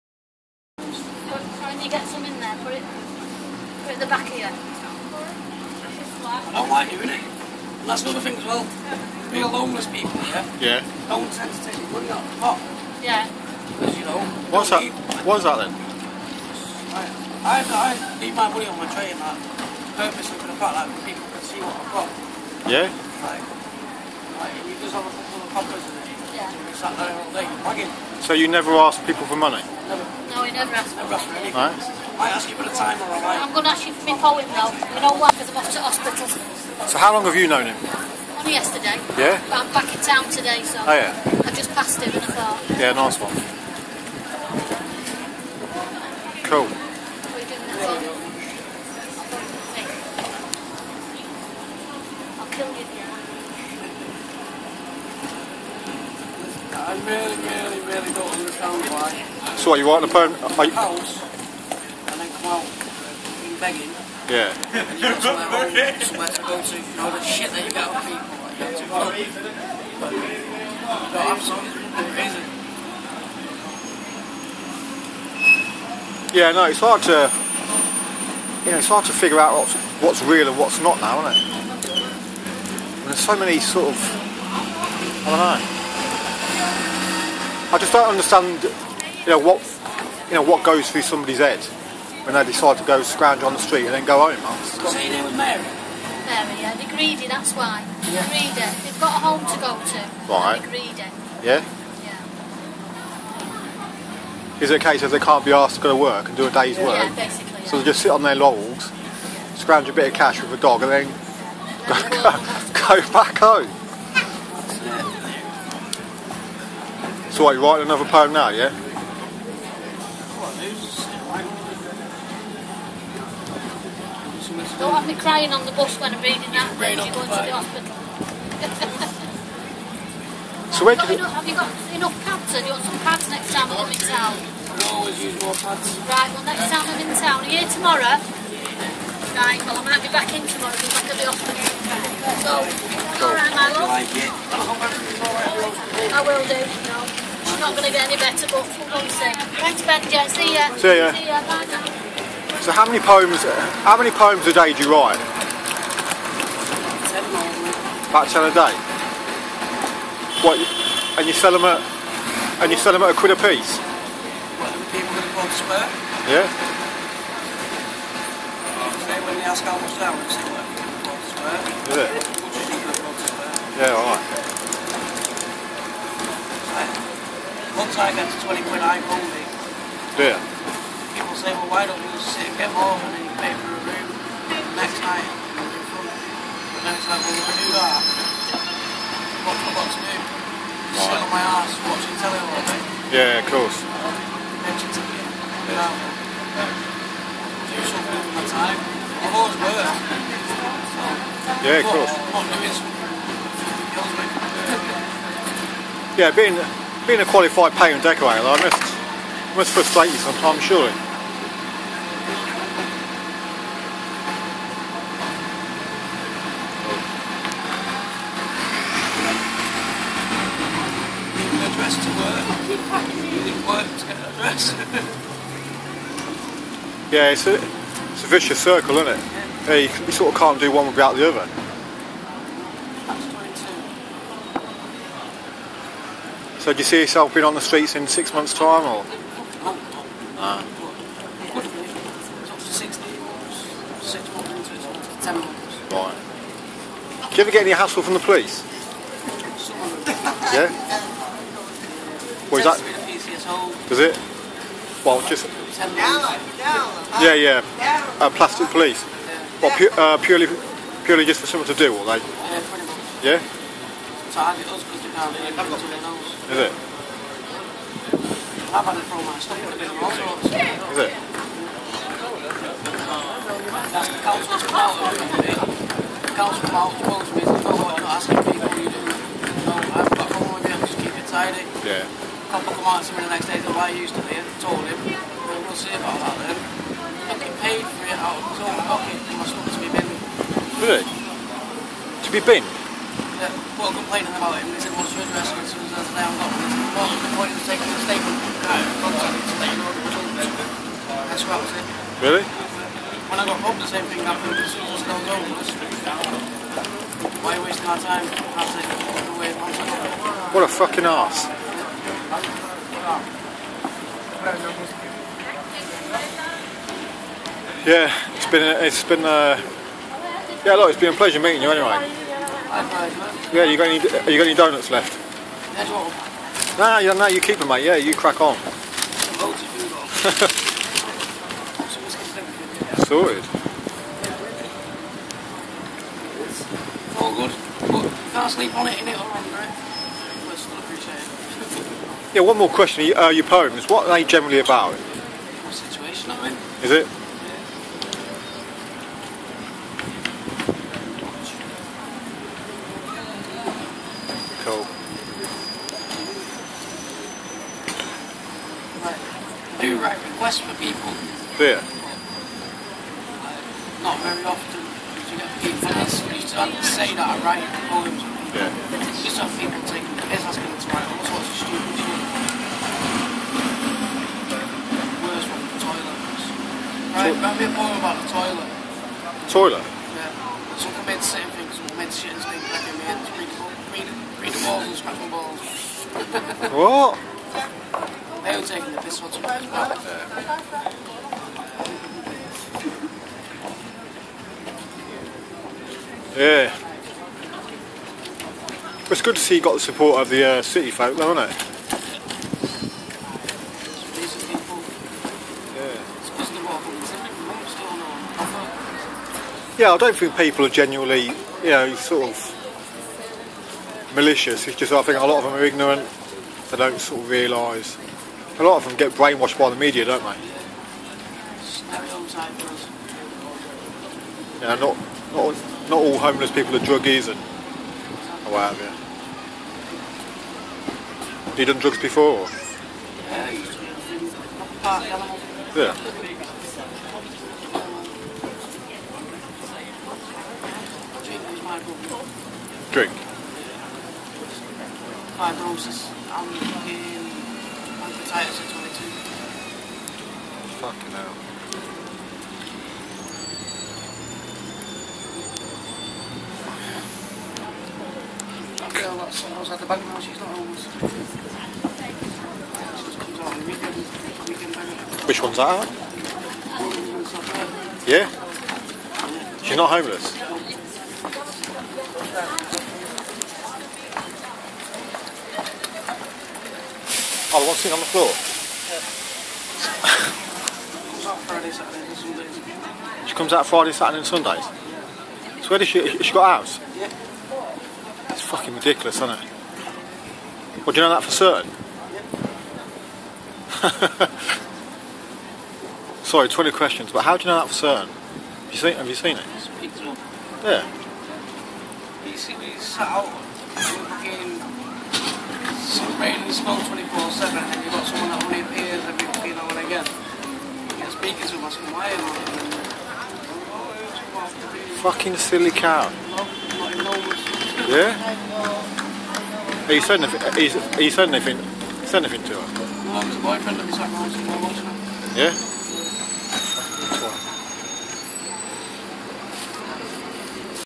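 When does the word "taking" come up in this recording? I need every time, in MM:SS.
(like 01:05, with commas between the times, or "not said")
04:57, 06:09, 06:28.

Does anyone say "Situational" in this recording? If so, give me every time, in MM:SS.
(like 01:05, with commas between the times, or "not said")
05:45.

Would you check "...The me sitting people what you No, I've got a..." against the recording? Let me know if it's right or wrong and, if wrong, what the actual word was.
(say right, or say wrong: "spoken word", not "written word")
wrong: "asking", not "sitting".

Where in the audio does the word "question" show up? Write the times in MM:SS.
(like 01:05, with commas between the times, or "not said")
05:42, 08:16.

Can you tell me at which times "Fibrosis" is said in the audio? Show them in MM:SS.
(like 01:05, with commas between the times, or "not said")
07:26.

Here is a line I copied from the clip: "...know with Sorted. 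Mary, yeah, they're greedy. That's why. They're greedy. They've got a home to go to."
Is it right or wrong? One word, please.
wrong.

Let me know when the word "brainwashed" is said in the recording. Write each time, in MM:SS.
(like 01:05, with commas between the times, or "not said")
06:59.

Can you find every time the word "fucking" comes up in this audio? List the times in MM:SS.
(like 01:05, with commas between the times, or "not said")
05:10, 08:08, 08:35.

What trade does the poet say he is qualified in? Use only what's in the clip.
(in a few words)
painter and decorator.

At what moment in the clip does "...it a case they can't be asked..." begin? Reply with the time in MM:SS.
01:44.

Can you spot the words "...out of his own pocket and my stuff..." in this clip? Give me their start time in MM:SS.
04:48.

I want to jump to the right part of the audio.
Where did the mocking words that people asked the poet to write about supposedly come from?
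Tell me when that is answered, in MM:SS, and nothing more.
06:15.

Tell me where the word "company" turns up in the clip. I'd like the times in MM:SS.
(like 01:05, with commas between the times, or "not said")
not said.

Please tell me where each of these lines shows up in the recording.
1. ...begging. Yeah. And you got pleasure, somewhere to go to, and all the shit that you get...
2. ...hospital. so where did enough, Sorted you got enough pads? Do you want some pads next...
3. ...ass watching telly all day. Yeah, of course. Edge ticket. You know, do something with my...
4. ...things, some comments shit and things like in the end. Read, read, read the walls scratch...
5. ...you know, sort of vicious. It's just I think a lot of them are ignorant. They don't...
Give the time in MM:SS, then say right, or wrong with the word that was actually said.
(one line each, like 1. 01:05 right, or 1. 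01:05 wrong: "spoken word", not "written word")
1. 01:03 wrong: "somewhere", not "pleasure"
2. 02:07 wrong: "Have", not "Sorted"
3. 03:11 right
4. 06:21 right
5. 06:51 wrong: "malicious", not "vicious".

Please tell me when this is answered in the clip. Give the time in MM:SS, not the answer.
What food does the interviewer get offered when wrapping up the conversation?
05:24.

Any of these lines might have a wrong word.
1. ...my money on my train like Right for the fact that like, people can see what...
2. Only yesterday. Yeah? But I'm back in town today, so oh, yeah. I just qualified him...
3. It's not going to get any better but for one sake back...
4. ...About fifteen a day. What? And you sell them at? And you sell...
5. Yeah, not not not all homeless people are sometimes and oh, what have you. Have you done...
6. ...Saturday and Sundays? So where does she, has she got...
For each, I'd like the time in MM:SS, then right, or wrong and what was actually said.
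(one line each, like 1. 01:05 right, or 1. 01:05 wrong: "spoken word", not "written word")
1. 00:18 wrong: "Purposely", not "Right"
2. 00:38 wrong: "passed", not "qualified"
3. 02:27 right
4. 02:38 wrong: "ten", not "fifteen"
5. 07:04 wrong: "druggies", not "sometimes"
6. 08:03 right.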